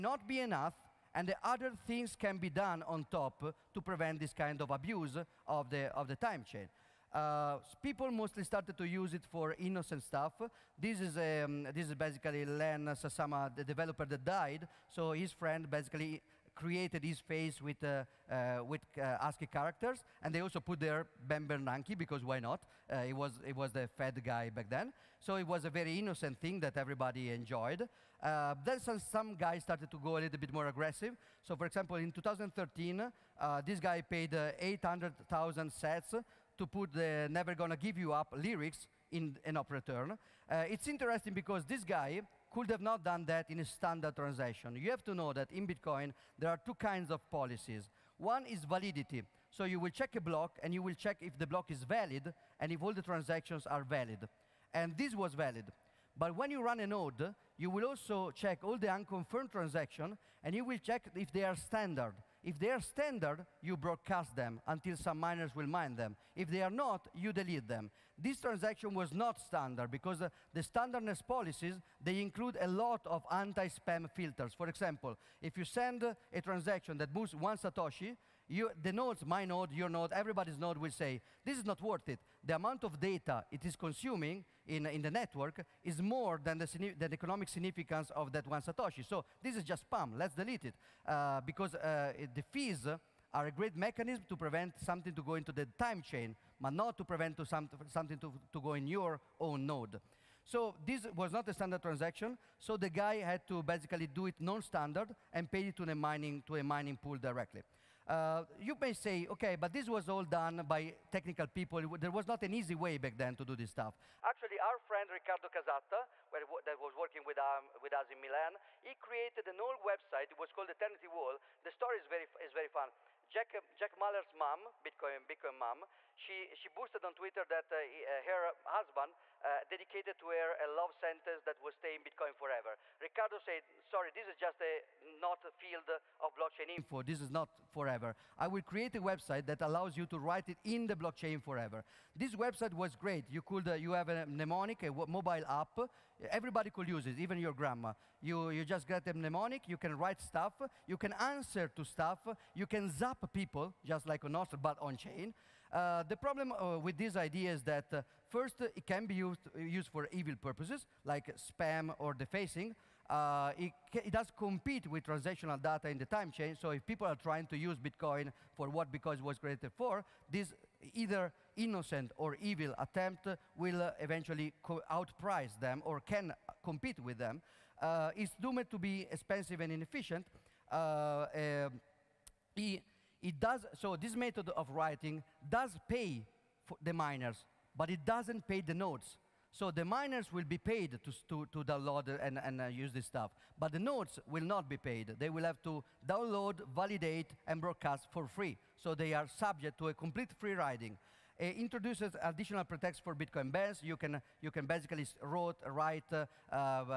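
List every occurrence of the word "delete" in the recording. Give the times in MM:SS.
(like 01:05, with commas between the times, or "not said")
01:07, 01:30.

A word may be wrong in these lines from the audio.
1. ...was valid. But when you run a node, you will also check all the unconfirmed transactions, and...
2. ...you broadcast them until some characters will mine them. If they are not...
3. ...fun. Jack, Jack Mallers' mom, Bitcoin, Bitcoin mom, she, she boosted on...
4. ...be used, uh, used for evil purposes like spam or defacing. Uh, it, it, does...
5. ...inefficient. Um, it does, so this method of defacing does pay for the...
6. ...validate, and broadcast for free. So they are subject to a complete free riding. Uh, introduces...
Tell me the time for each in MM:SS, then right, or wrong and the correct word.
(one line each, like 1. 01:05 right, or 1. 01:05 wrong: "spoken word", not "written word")
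1. 00:55 right
2. 01:03 wrong: "miners", not "characters"
3. 02:02 right
4. 02:39 right
5. 02:59 wrong: "writing", not "defacing"
6. 03:16 right.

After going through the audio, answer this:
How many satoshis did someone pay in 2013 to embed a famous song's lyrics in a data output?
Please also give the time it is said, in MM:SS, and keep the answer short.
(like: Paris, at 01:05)
800,000 sats, at 00:34.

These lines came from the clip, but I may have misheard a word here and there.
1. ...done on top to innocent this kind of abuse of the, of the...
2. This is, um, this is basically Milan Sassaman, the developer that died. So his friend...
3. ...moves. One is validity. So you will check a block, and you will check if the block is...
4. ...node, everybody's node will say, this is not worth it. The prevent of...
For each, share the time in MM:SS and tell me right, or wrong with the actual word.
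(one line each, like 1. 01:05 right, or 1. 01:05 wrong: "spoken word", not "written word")
1. 00:02 wrong: "prevent", not "innocent"
2. 00:10 wrong: "Len", not "Milan"
3. 00:47 wrong: "policies", not "moves"
4. 01:19 wrong: "amount", not "prevent".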